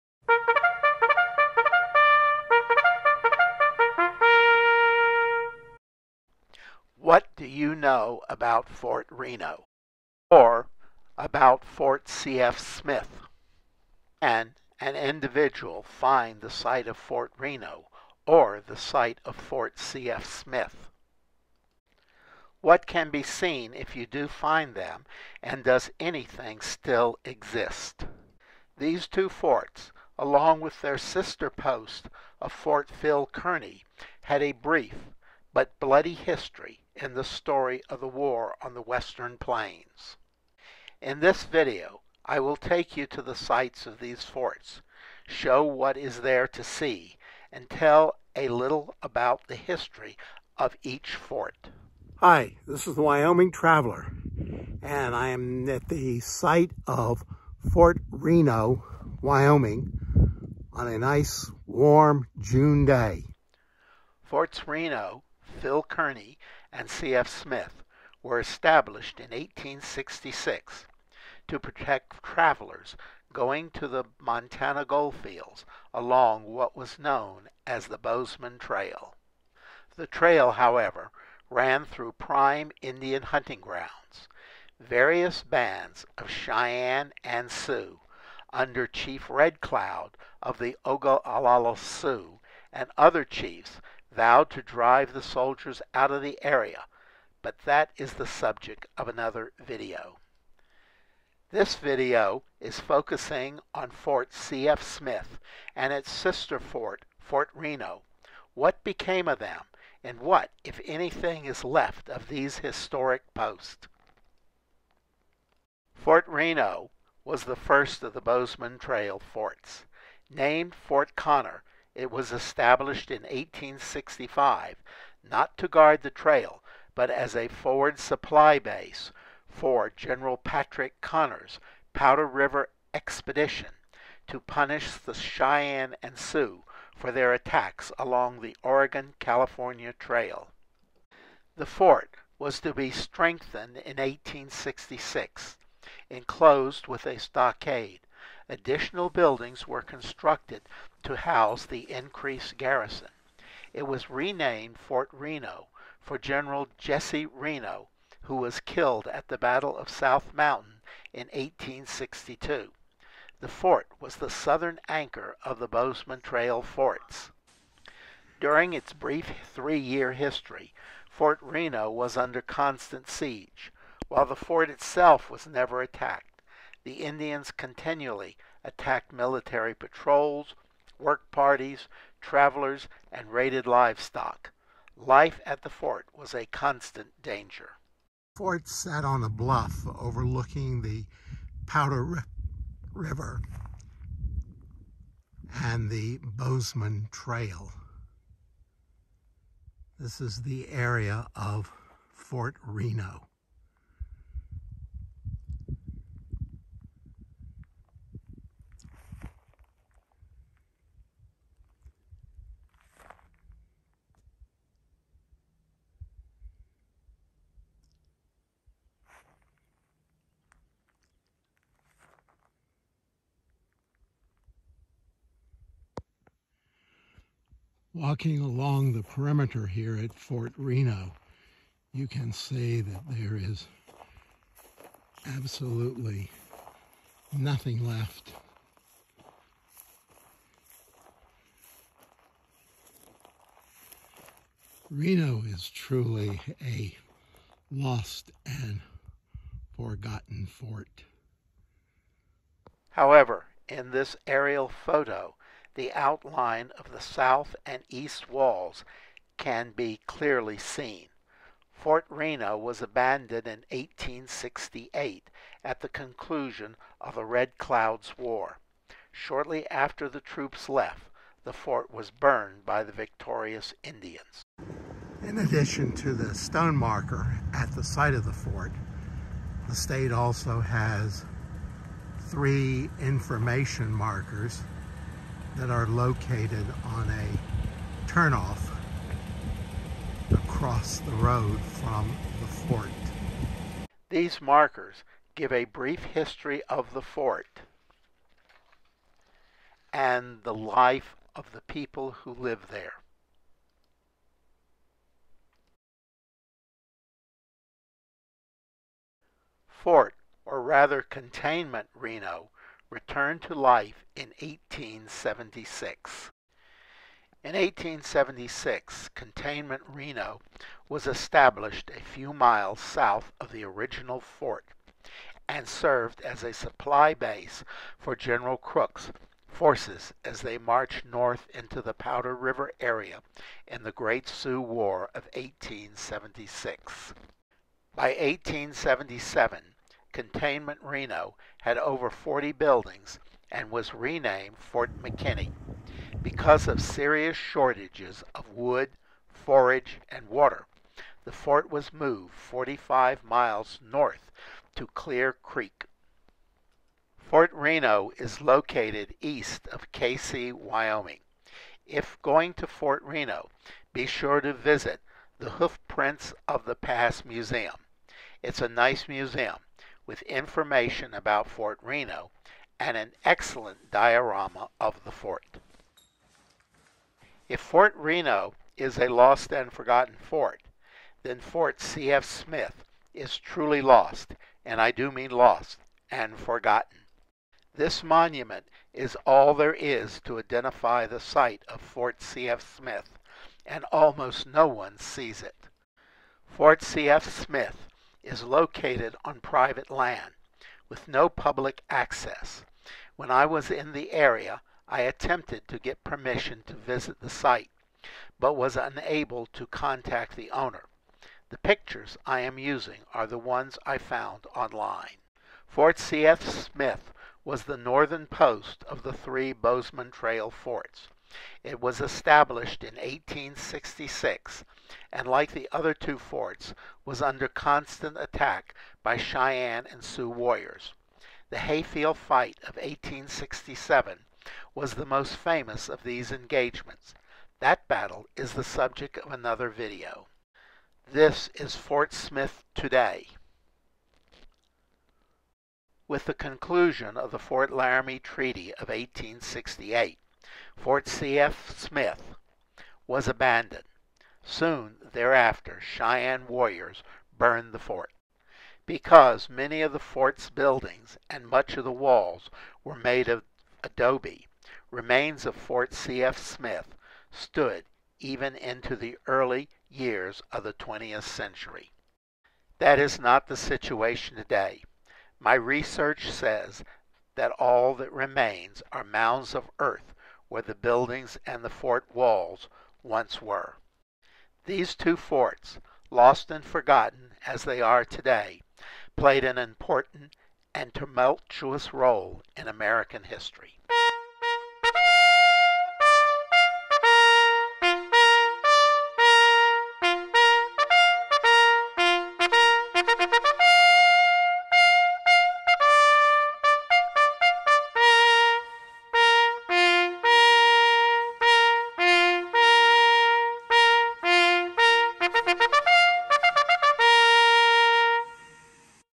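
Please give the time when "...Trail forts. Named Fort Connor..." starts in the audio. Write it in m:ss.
1:58.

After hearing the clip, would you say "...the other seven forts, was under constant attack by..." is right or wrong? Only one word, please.
wrong.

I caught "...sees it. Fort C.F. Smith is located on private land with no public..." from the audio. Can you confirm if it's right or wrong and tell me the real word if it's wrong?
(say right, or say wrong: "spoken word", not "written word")
right.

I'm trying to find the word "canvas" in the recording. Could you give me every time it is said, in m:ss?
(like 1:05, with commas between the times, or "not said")
not said.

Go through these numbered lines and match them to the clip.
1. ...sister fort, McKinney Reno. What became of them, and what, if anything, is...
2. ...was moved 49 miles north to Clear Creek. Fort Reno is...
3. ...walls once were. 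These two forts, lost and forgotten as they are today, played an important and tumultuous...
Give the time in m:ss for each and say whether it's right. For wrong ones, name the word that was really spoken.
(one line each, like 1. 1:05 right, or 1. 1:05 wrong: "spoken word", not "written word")
1. 1:46 wrong: "Fort", not "McKinney"
2. 5:51 wrong: "45", not "49"
3. 8:02 right.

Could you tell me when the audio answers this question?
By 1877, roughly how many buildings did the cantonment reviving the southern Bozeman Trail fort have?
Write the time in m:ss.
5:41.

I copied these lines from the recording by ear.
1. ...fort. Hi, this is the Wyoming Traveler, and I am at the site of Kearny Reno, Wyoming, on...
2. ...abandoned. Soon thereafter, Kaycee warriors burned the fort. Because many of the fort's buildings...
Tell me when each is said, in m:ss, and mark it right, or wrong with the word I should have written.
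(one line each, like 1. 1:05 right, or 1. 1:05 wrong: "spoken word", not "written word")
1. 0:51 wrong: "Fort", not "Kearny"
2. 7:33 wrong: "Cheyenne", not "Kaycee".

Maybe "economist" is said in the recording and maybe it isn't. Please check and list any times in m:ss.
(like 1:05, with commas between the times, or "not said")
not said.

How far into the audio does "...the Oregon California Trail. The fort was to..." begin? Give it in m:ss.
2:18.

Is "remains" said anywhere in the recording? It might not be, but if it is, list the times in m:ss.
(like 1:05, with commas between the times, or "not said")
7:44, 7:58.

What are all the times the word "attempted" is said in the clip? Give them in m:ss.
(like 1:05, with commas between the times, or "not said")
6:45.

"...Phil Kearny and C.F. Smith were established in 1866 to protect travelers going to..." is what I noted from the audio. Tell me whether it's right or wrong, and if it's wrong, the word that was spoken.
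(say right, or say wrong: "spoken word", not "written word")
right.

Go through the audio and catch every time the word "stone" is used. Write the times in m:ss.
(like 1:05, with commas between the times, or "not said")
4:36.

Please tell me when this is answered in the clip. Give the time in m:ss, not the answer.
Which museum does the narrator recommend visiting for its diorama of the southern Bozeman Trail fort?
6:05.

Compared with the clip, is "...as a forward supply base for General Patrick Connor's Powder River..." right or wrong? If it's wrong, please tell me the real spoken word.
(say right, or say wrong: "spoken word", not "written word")
right.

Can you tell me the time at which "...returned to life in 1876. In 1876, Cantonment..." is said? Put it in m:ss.
5:12.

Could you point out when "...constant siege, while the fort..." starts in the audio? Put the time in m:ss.
2:52.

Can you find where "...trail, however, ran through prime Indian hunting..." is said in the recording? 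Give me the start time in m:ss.
1:20.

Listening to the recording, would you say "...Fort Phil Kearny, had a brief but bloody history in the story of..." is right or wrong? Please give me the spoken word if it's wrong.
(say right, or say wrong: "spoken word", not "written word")
right.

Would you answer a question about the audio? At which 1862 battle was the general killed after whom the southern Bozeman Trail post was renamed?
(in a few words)
Battle of South Mountain.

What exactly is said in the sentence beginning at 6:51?
The pictures I am using are the ones I found online.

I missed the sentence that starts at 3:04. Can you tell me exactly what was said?
Life at the fort was a constant danger.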